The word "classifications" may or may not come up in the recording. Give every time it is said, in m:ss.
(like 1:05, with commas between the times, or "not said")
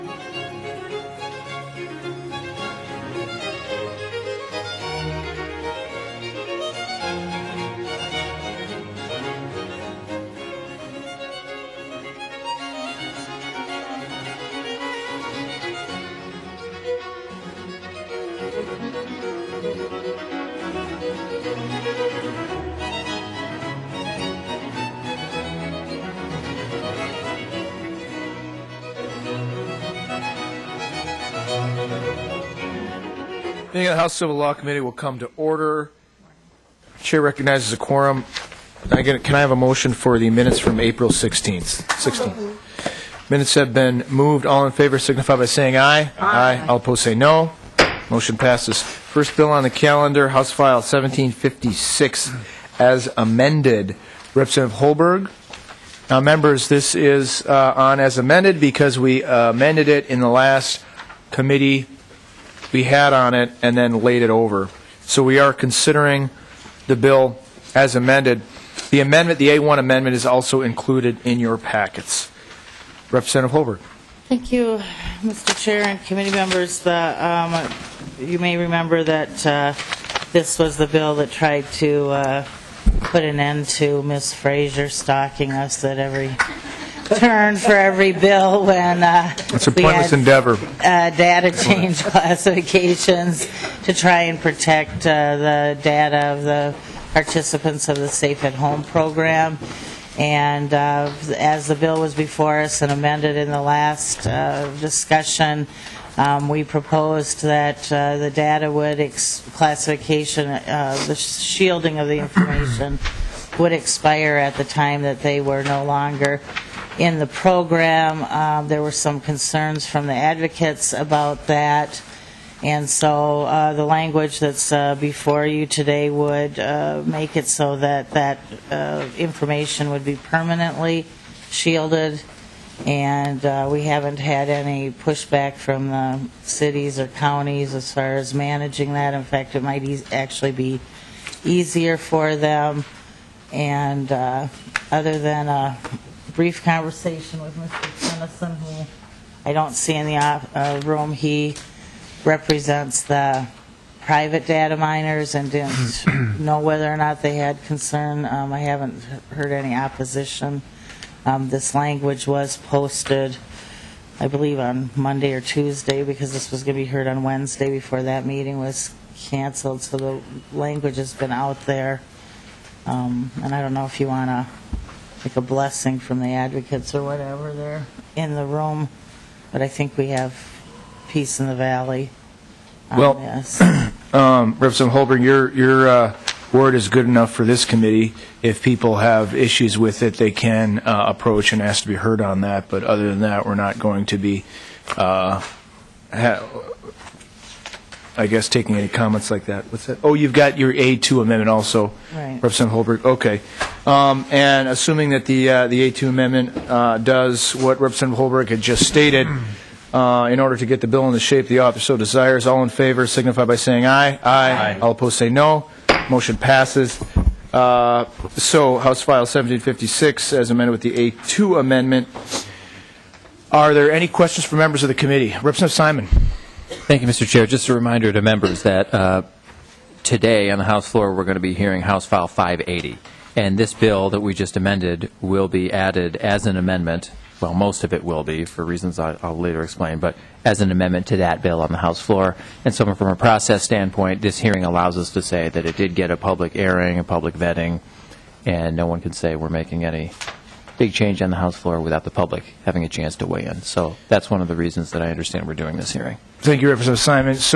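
1:32, 1:49.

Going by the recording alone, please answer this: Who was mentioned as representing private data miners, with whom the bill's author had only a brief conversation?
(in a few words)
Mr. Tennyson.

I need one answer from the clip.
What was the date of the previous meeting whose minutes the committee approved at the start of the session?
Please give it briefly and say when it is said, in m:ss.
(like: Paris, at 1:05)
April 16th, at 0:40.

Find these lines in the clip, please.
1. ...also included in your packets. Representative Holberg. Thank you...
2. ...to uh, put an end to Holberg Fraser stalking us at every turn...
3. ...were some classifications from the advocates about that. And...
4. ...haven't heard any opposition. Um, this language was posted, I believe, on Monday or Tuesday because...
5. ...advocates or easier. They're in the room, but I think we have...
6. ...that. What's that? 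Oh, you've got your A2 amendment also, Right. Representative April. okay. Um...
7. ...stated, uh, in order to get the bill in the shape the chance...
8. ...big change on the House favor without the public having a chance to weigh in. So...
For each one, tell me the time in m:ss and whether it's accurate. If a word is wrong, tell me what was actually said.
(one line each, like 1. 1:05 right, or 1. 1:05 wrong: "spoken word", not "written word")
1. 1:10 right
2. 1:21 wrong: "Miss", not "Holberg"
3. 1:58 wrong: "concerns", not "classifications"
4. 2:38 right
5. 2:56 wrong: "whatever", not "easier"
6. 3:19 wrong: "Holberg", not "April"
7. 3:28 wrong: "office", not "chance"
8. 4:10 wrong: "floor", not "favor".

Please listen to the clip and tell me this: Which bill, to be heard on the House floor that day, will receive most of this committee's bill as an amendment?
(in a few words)
House File 580.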